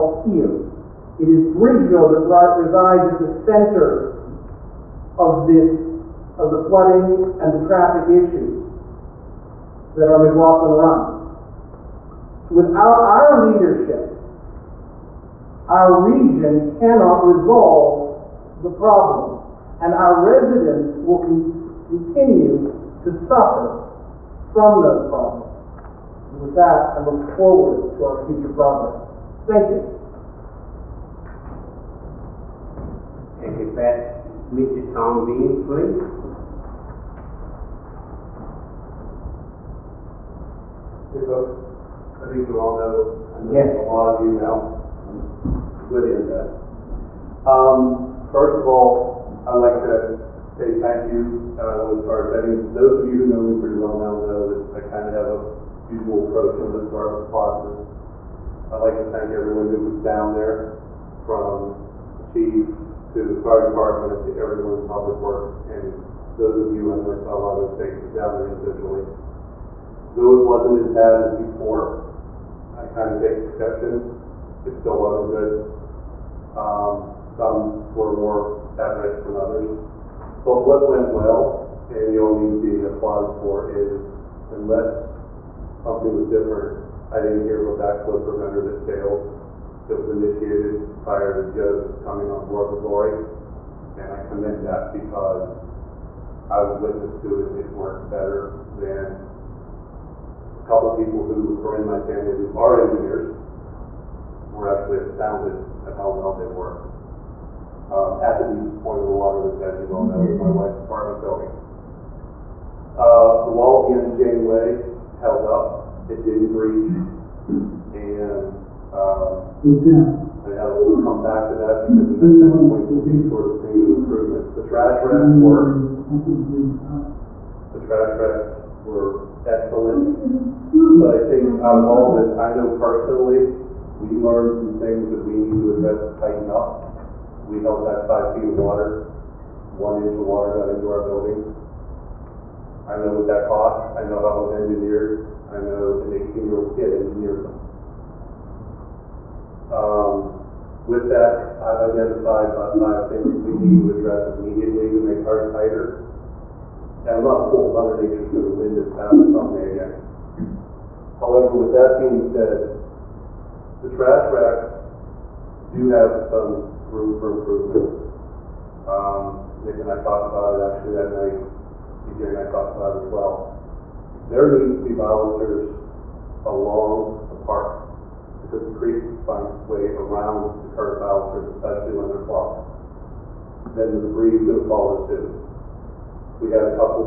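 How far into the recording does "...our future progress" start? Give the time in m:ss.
0:28.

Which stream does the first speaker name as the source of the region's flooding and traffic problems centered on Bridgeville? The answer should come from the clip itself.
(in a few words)
McLaughlin Run.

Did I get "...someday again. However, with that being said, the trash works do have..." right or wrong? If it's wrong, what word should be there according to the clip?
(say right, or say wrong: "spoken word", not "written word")
wrong: "racks", not "works".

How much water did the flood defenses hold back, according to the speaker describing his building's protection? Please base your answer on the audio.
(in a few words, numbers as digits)
5 feet.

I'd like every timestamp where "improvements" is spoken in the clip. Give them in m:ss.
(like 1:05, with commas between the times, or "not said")
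2:03, 2:47.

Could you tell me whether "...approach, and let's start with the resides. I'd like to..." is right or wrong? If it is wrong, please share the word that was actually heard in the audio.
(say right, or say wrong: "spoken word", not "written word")
wrong: "positives", not "resides".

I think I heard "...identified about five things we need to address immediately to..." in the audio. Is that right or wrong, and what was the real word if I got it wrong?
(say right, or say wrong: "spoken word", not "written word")
right.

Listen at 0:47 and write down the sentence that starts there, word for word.
Um, first of all, I'd like to say thank you, and I want to start.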